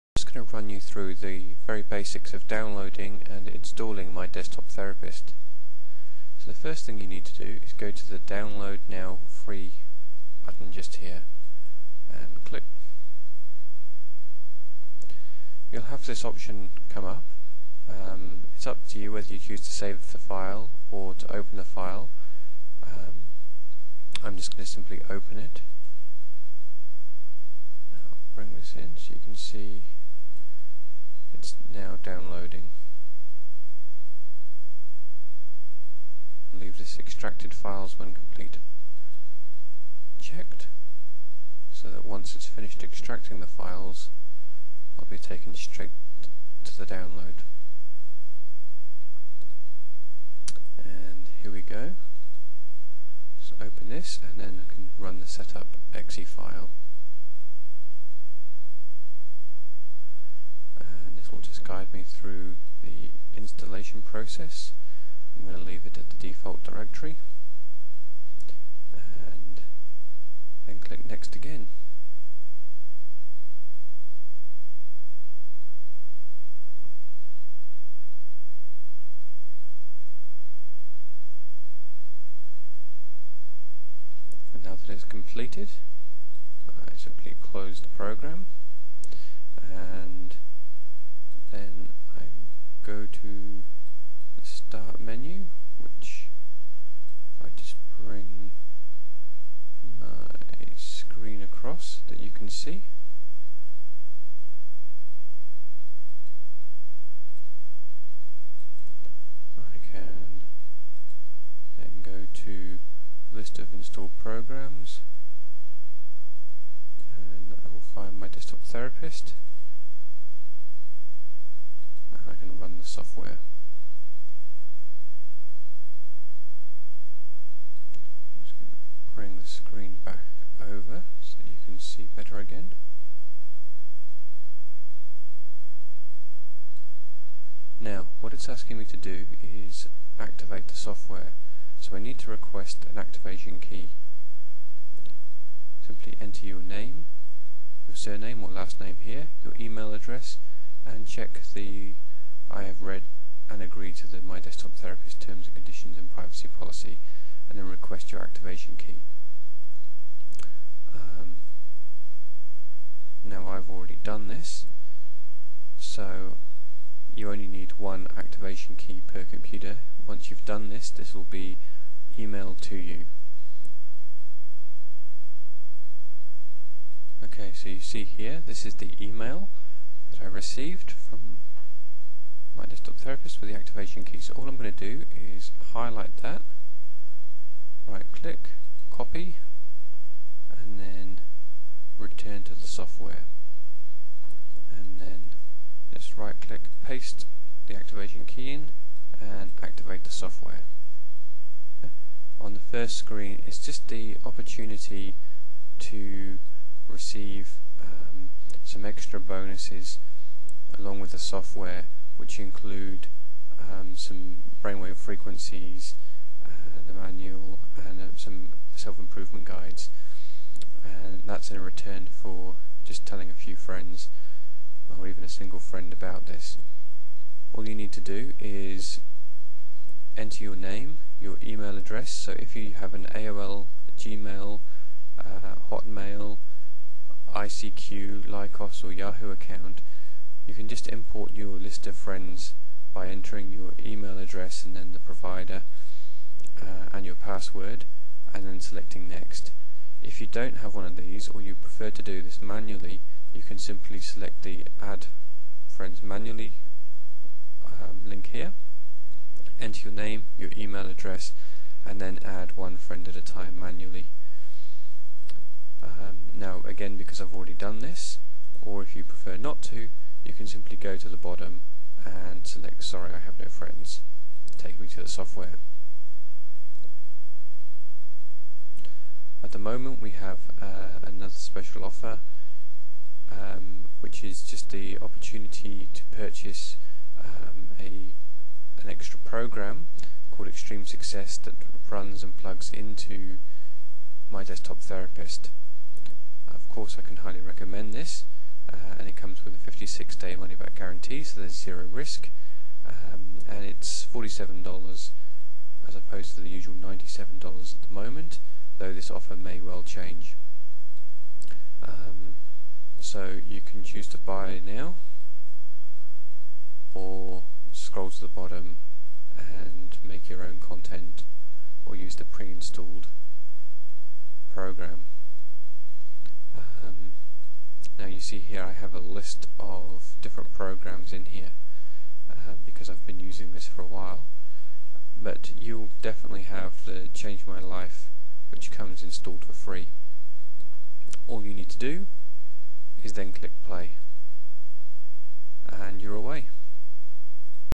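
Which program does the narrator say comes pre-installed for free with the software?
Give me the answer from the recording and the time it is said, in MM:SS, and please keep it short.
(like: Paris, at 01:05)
Change My Life, at 05:37.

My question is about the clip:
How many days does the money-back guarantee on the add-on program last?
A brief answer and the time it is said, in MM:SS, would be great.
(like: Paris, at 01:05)
56, at 04:59.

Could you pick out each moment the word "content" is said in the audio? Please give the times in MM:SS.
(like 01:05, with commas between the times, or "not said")
05:20.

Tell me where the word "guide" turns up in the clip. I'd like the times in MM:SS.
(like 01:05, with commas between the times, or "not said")
01:01, 03:39.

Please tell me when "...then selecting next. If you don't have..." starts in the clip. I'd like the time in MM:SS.
04:08.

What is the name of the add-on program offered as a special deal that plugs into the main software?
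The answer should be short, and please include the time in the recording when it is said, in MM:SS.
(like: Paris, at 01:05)
Extreme Success, at 04:50.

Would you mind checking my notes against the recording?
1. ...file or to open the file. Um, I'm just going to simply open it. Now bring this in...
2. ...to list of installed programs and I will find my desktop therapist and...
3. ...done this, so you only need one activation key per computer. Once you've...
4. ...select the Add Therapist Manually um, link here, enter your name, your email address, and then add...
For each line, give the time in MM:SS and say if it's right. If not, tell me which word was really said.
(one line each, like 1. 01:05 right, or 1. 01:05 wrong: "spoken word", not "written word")
1. 00:20 right
2. 01:52 right
3. 02:44 right
4. 04:13 wrong: "Friends", not "Therapist".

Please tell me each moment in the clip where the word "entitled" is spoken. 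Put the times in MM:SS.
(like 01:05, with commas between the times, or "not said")
not said.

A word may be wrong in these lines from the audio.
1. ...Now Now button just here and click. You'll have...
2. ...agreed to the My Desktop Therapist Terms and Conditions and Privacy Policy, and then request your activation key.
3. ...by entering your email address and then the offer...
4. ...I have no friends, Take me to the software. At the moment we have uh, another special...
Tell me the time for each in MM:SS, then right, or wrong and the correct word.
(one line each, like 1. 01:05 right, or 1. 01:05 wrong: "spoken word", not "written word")
1. 00:08 wrong: "Free", not "Now"
2. 02:33 right
3. 04:02 wrong: "provider", not "offer"
4. 04:33 right.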